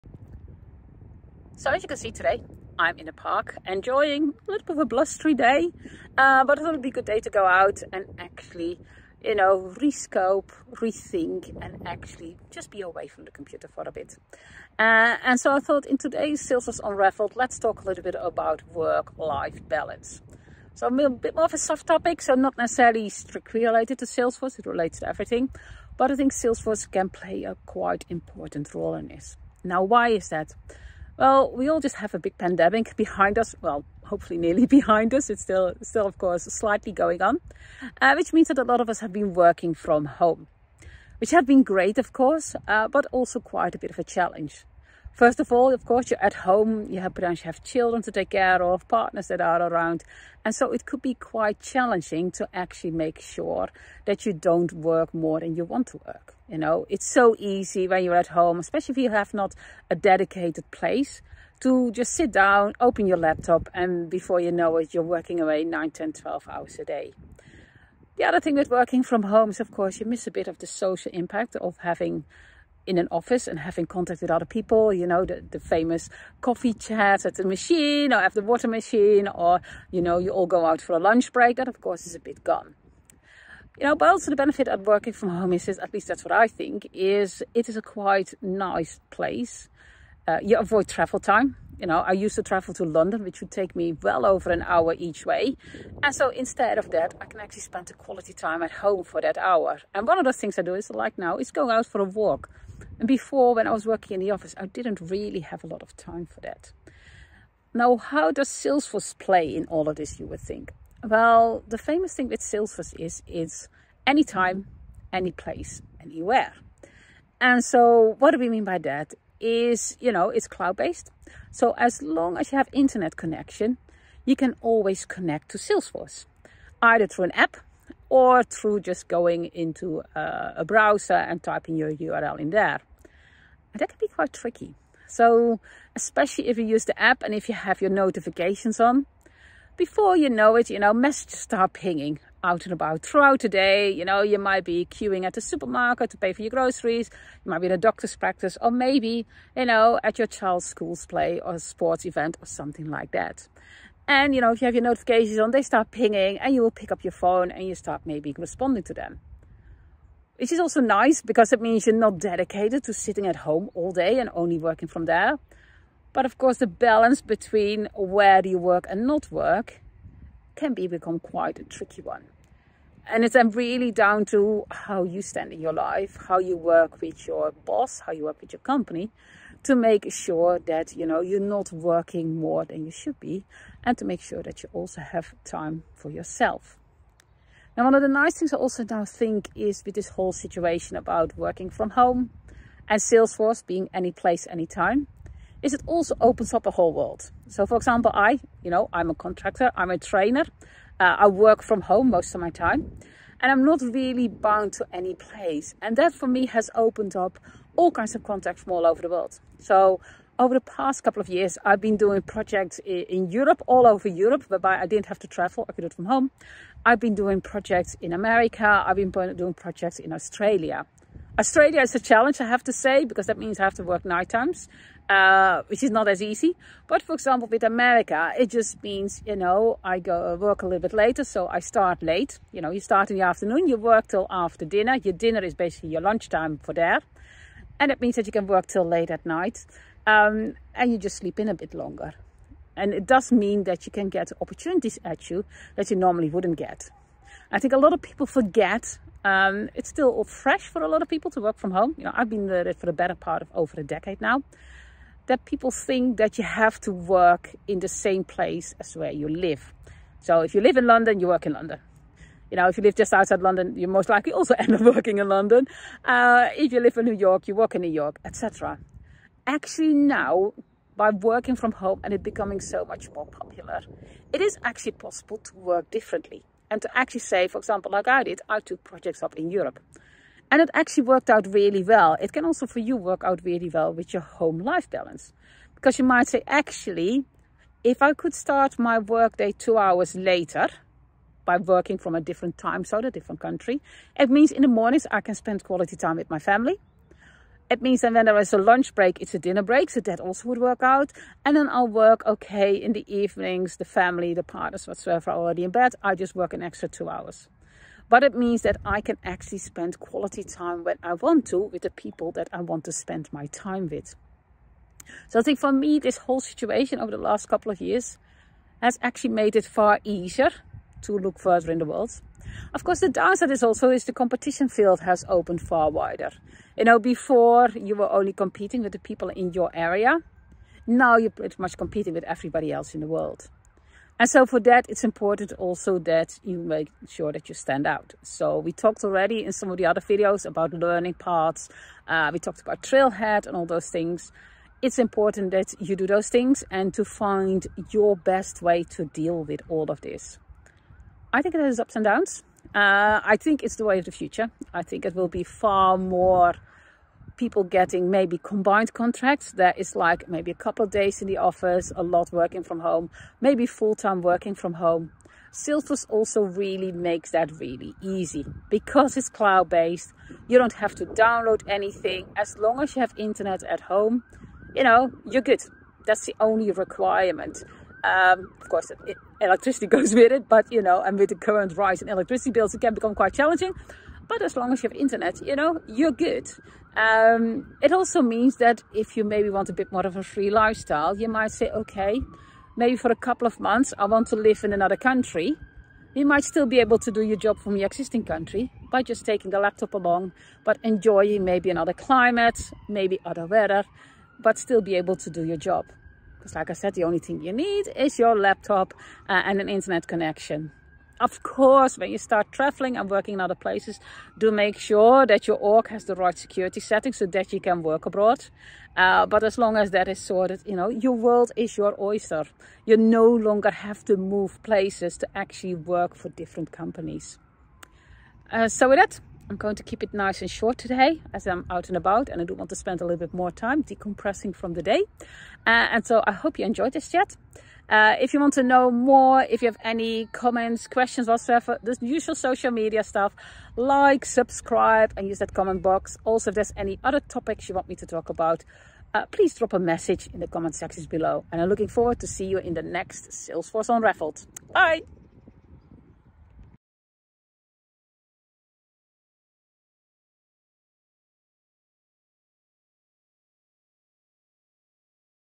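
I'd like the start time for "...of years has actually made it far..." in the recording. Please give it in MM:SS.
05:17.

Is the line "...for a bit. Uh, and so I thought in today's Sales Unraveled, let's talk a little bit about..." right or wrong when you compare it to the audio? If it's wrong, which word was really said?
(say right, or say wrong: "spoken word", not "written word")
right.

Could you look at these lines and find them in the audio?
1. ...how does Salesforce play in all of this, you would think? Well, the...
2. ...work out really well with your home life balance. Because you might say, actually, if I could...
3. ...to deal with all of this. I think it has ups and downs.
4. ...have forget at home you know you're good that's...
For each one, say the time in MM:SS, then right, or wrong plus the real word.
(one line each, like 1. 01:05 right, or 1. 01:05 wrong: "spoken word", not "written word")
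1. 01:47 right
2. 04:42 right
3. 05:48 right
4. 06:13 wrong: "internet", not "forget".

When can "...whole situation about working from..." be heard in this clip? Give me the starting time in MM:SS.
03:10.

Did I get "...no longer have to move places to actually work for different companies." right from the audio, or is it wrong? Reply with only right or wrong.
right.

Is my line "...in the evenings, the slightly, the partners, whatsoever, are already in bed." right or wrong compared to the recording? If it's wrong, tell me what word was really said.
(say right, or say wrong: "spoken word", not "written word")
wrong: "family", not "slightly".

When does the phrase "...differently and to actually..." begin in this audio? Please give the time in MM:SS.
04:35.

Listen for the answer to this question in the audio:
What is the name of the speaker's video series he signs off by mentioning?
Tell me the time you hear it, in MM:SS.
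07:33.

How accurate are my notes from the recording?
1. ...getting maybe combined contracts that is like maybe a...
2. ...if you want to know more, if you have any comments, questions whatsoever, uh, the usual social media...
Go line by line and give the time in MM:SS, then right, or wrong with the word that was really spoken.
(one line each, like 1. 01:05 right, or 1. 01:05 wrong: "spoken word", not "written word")
1. 05:57 right
2. 07:18 right.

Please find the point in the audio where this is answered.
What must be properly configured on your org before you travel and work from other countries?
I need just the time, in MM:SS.
06:56.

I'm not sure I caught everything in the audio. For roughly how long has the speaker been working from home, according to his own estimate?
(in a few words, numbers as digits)
over a decade.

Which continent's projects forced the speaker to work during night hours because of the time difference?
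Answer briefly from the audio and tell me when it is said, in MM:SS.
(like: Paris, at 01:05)
Australia, at 03:41.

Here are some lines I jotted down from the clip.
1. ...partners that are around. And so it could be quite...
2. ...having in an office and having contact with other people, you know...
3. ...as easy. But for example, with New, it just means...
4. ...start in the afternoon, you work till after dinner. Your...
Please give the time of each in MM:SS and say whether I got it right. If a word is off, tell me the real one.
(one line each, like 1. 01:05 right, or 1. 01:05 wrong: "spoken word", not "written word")
1. 00:48 right
2. 01:11 right
3. 03:46 wrong: "America", not "New"
4. 03:52 right.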